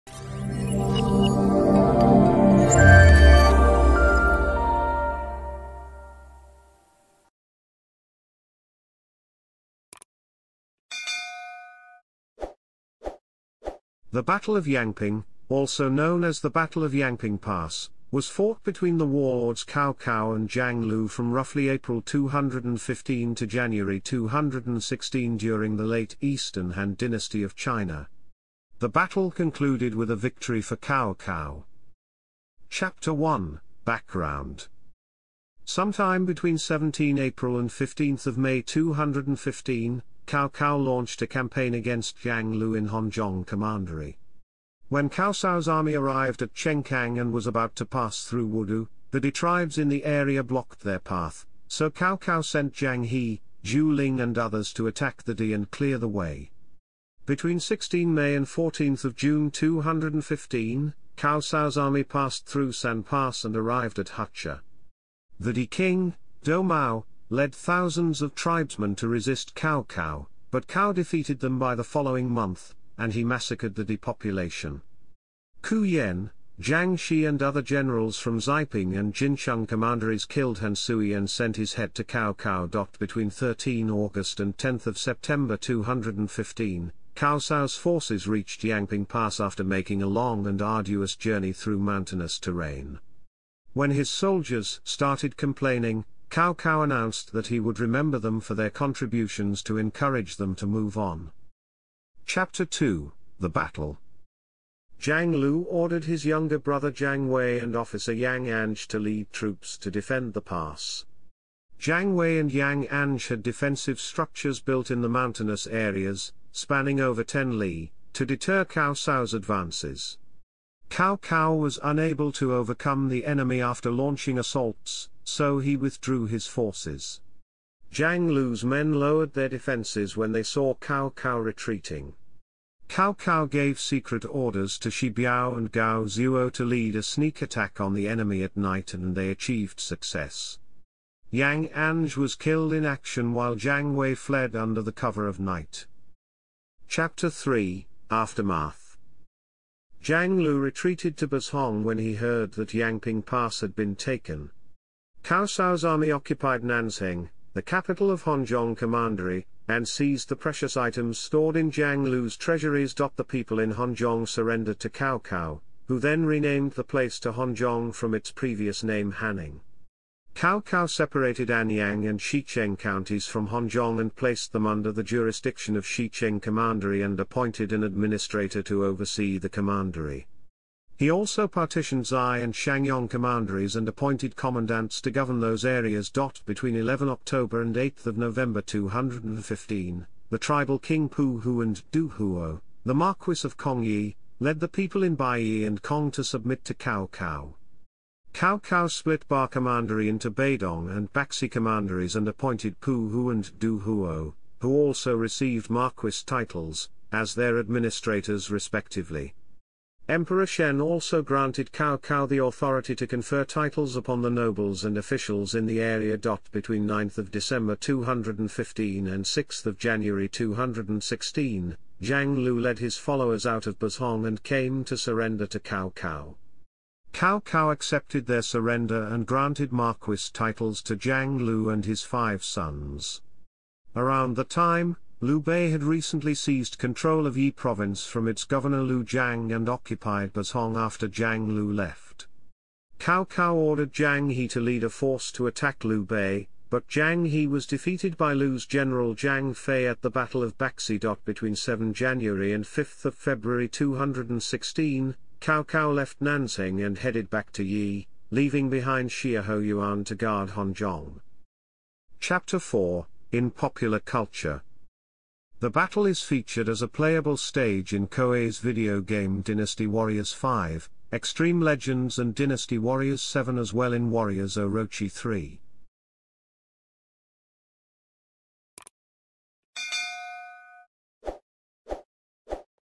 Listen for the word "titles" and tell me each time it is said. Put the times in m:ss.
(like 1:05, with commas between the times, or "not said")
3:26, 3:33, 3:50.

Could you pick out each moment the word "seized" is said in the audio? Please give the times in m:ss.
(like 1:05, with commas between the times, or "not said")
2:39, 3:56.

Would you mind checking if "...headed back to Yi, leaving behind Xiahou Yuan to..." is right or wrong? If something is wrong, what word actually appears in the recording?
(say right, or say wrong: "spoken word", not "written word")
right.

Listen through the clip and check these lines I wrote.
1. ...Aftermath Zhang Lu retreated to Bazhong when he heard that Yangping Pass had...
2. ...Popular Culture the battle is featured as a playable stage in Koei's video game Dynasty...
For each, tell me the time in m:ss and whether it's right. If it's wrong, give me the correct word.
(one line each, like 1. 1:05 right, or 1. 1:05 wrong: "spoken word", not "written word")
1. 2:28 right
2. 4:23 right.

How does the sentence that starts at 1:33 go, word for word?
When his soldiers started complaining, Cao Cao announced that he would remember them for their contributions to encourage them to move on.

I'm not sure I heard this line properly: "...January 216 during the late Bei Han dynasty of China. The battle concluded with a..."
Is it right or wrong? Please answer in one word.
wrong.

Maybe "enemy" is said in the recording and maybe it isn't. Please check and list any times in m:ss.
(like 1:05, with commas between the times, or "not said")
2:03, 2:18.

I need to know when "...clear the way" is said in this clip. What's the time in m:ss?
0:55.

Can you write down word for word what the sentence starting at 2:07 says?
Zhang Lu's men lowered their defenses when they saw Cao Cao retreating.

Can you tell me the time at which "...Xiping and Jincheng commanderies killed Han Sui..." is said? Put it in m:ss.
1:18.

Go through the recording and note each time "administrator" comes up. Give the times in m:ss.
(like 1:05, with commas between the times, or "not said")
2:57, 3:27.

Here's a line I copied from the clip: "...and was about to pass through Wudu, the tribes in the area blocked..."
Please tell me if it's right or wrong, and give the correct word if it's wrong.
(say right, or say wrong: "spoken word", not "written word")
right.